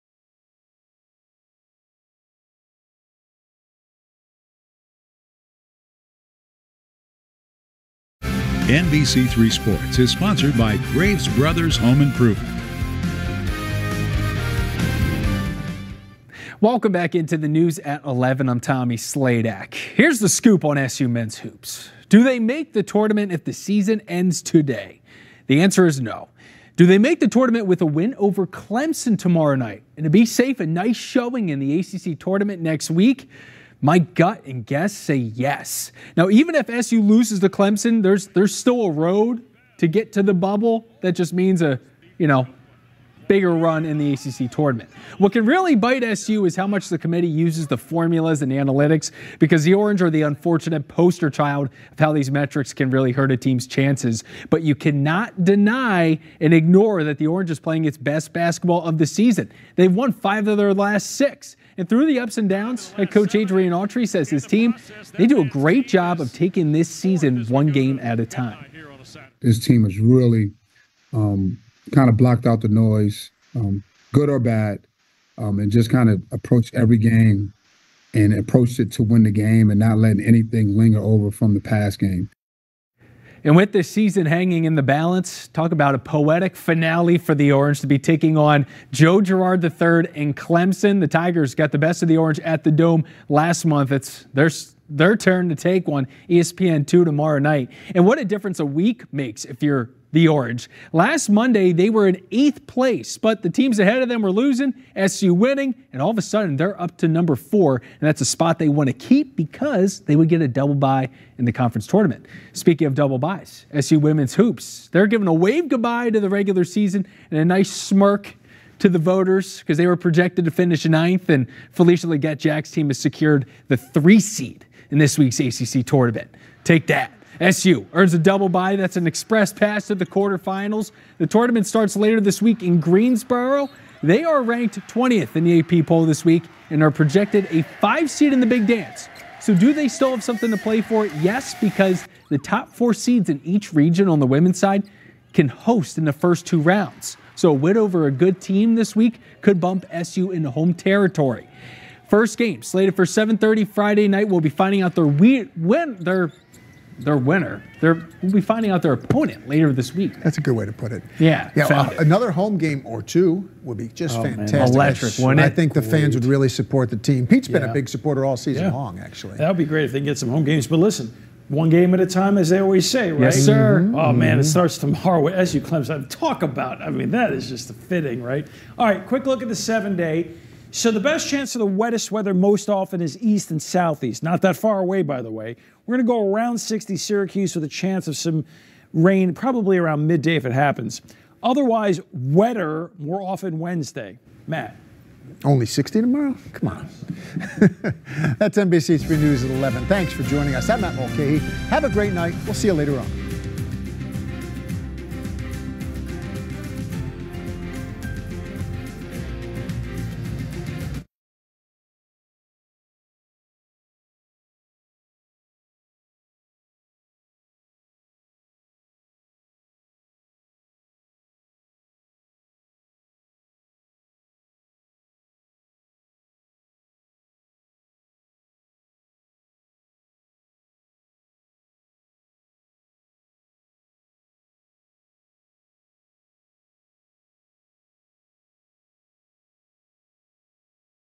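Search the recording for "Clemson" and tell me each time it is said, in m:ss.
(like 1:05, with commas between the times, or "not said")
0:28, 0:37, 1:30, 2:55.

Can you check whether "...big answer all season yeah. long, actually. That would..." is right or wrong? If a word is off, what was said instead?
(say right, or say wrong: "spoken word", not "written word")
wrong: "supporter", not "answer".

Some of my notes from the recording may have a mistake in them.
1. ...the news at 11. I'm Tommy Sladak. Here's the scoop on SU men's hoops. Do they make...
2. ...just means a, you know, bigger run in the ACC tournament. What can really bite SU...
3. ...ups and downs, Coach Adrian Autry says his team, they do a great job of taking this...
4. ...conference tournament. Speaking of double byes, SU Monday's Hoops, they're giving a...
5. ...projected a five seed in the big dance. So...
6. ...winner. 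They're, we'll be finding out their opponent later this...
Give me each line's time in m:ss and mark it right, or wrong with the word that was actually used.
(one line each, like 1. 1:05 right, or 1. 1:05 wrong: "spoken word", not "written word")
1. 0:17 right
2. 0:41 right
3. 1:02 right
4. 1:51 wrong: "Women", not "Monday"
5. 2:16 right
6. 2:37 right.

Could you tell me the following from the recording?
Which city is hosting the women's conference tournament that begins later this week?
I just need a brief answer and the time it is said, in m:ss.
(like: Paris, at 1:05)
Greensboro, at 2:12.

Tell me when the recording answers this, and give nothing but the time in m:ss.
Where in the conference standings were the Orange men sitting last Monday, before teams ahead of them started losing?
1:42.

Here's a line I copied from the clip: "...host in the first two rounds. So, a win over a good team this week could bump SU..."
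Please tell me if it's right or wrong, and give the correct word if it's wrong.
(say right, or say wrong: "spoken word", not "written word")
right.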